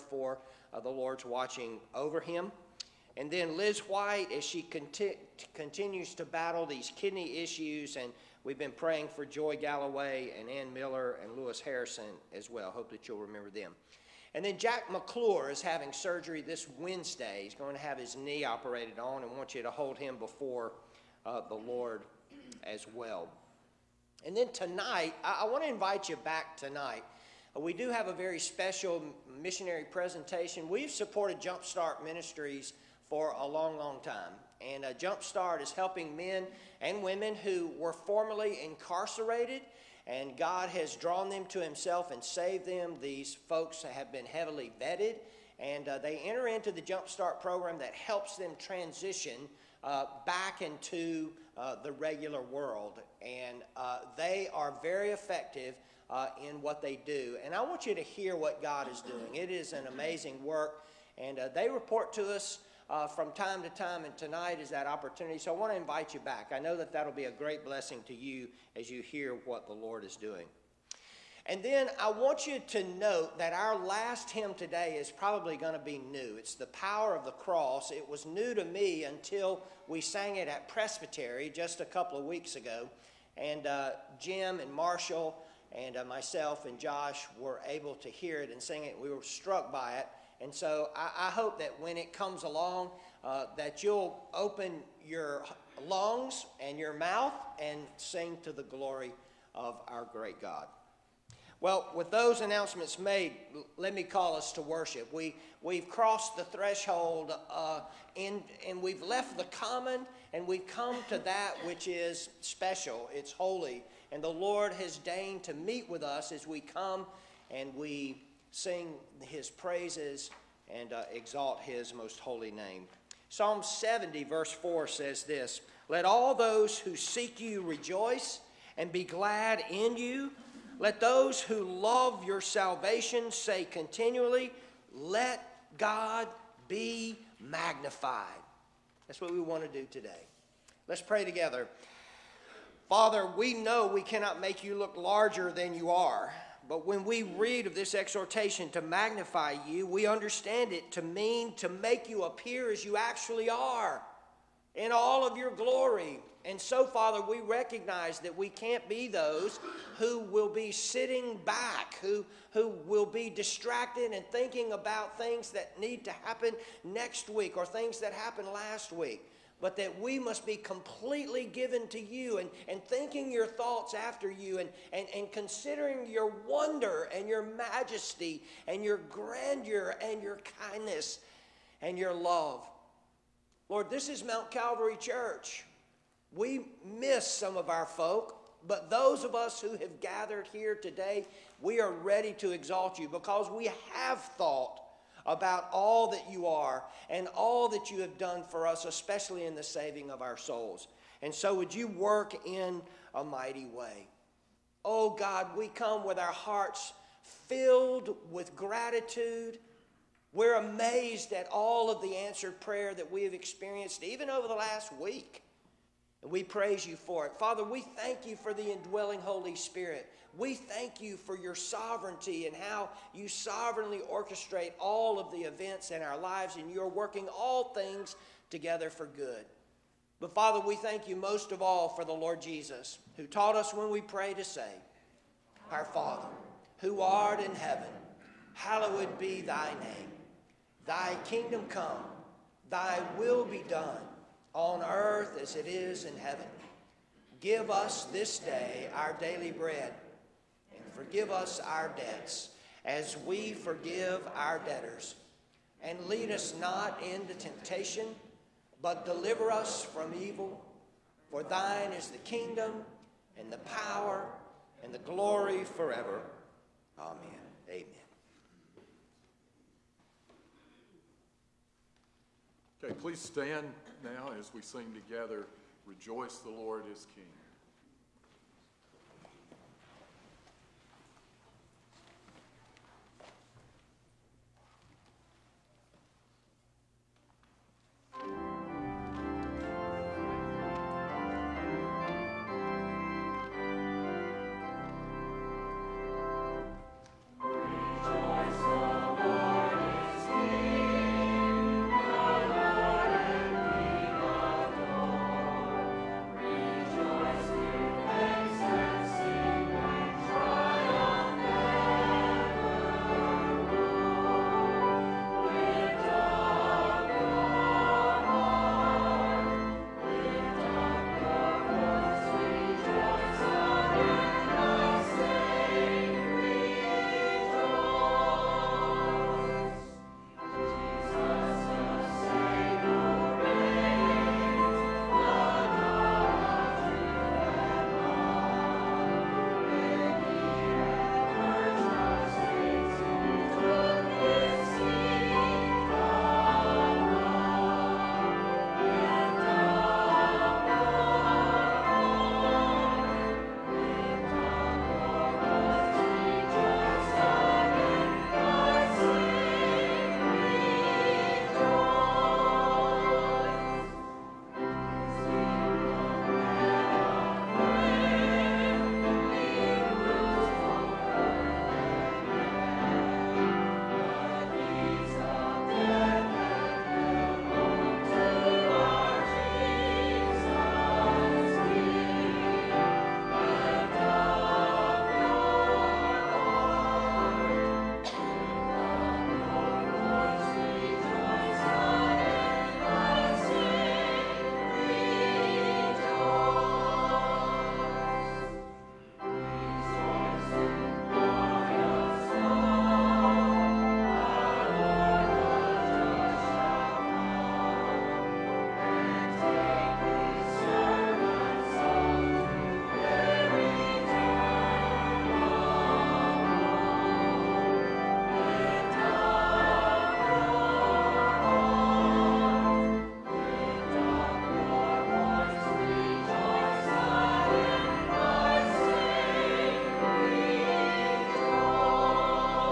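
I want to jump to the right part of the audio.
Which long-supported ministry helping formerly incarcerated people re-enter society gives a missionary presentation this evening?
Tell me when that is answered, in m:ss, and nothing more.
0:31.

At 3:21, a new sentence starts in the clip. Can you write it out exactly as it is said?
And so, would you work in a mighty way?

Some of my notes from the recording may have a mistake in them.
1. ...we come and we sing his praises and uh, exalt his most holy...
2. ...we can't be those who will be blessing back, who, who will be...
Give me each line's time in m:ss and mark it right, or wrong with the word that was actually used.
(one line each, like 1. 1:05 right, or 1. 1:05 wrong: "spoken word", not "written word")
1. 1:56 right
2. 2:38 wrong: "sitting", not "blessing".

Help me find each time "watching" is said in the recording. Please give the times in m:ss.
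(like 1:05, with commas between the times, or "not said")
0:01.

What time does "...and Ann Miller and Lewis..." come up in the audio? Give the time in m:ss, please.
0:10.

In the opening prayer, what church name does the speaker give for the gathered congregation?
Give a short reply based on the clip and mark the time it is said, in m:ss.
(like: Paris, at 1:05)
Mount Calvary Church, at 3:04.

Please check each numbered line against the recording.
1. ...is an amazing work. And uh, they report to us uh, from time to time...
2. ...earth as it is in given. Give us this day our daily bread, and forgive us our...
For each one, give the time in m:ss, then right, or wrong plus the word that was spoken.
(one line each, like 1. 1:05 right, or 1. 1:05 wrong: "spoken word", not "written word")
1. 0:59 right
2. 4:04 wrong: "heaven", not "given".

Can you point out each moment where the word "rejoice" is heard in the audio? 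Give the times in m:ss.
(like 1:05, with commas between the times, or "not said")
2:07, 4:35.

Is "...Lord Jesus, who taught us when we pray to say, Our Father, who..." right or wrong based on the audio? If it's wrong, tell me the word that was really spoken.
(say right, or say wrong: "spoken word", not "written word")
right.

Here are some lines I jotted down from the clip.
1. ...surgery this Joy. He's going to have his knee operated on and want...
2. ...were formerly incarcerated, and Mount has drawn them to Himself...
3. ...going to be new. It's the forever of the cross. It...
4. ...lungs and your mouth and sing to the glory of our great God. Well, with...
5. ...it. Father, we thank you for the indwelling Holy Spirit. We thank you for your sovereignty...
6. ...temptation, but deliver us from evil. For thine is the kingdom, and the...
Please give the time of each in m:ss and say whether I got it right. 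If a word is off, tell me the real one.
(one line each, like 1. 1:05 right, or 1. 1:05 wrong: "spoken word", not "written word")
1. 0:15 wrong: "Wednesday", not "Joy"
2. 0:37 wrong: "God", not "Mount"
3. 1:15 wrong: "power", not "forever"
4. 1:35 right
5. 3:37 right
6. 4:17 right.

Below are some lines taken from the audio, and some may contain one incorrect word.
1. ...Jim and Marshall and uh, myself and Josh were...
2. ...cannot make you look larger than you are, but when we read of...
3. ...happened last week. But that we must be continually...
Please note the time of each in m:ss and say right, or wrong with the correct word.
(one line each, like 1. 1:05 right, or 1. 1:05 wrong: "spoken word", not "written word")
1. 1:24 right
2. 2:23 right
3. 2:48 wrong: "completely", not "continually".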